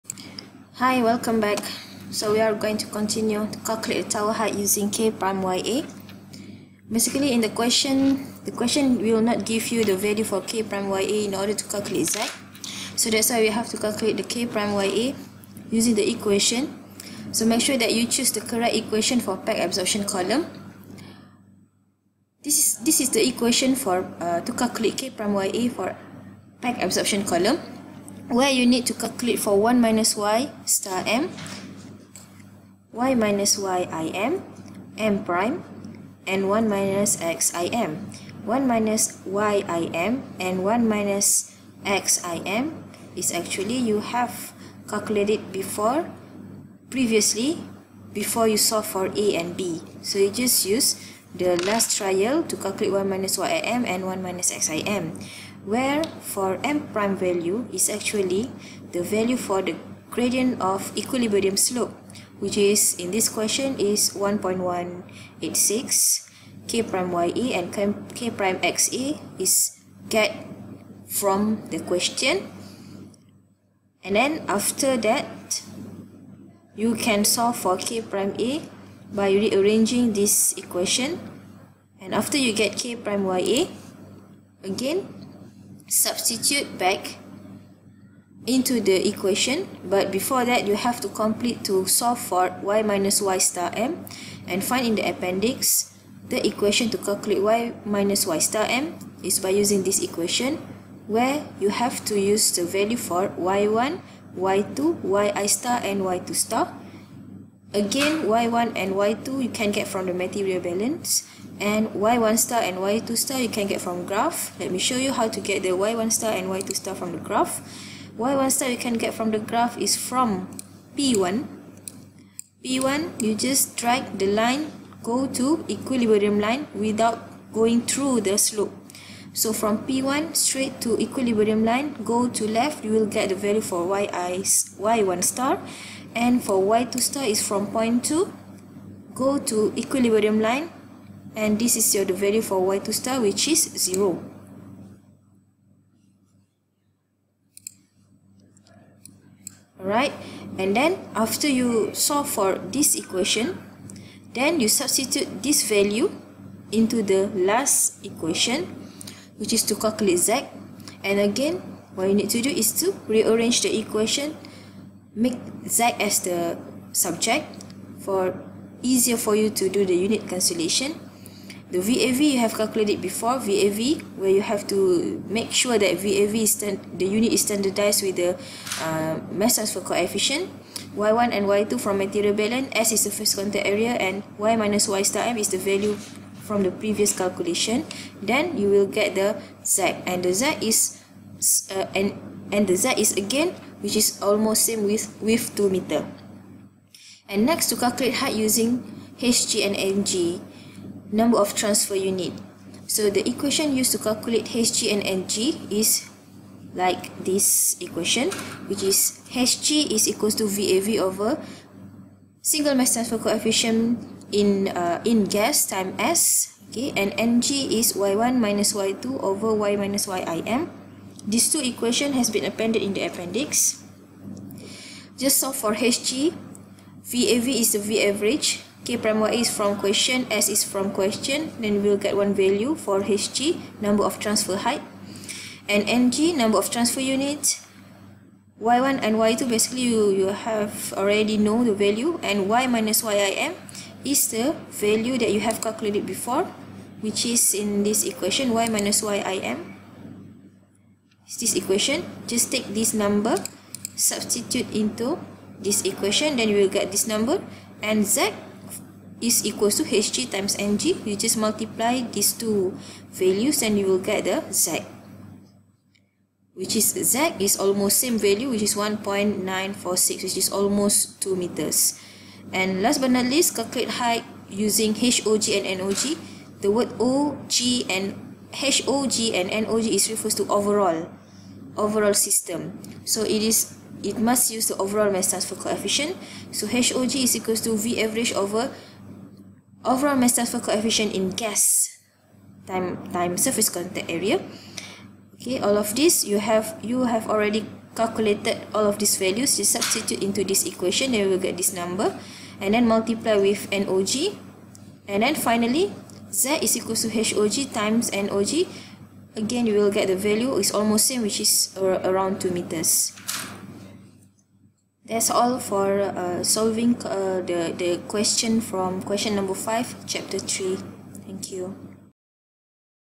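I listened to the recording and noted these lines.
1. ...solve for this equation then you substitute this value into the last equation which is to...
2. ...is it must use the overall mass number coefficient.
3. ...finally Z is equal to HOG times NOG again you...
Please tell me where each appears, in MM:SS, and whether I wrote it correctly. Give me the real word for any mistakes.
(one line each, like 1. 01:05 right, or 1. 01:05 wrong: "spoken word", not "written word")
1. 02:31 right
2. 04:43 wrong: "transfer", not "number"
3. 05:05 right.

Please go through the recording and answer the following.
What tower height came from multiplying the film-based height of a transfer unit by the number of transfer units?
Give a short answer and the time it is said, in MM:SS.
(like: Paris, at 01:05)
1.946, at 04:28.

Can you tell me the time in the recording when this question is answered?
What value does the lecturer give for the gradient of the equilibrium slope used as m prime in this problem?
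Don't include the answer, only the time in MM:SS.
01:04.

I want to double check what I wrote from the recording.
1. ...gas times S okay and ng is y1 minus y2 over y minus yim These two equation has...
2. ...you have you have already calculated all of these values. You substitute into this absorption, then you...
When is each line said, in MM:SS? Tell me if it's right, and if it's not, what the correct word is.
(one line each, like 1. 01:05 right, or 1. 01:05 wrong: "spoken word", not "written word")
1. 03:35 right
2. 04:56 wrong: "equation", not "absorption".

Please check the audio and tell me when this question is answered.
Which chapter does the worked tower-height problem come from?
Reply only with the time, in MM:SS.
05:20.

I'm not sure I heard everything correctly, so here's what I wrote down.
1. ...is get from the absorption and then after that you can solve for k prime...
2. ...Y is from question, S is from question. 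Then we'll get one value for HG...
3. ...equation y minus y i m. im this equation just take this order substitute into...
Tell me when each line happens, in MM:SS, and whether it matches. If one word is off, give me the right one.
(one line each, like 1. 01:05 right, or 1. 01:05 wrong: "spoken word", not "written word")
1. 01:09 wrong: "question", not "absorption"
2. 03:49 right
3. 04:08 wrong: "number", not "order".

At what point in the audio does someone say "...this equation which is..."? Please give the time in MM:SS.
03:27.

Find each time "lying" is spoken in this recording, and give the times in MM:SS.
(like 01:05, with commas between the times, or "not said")
not said.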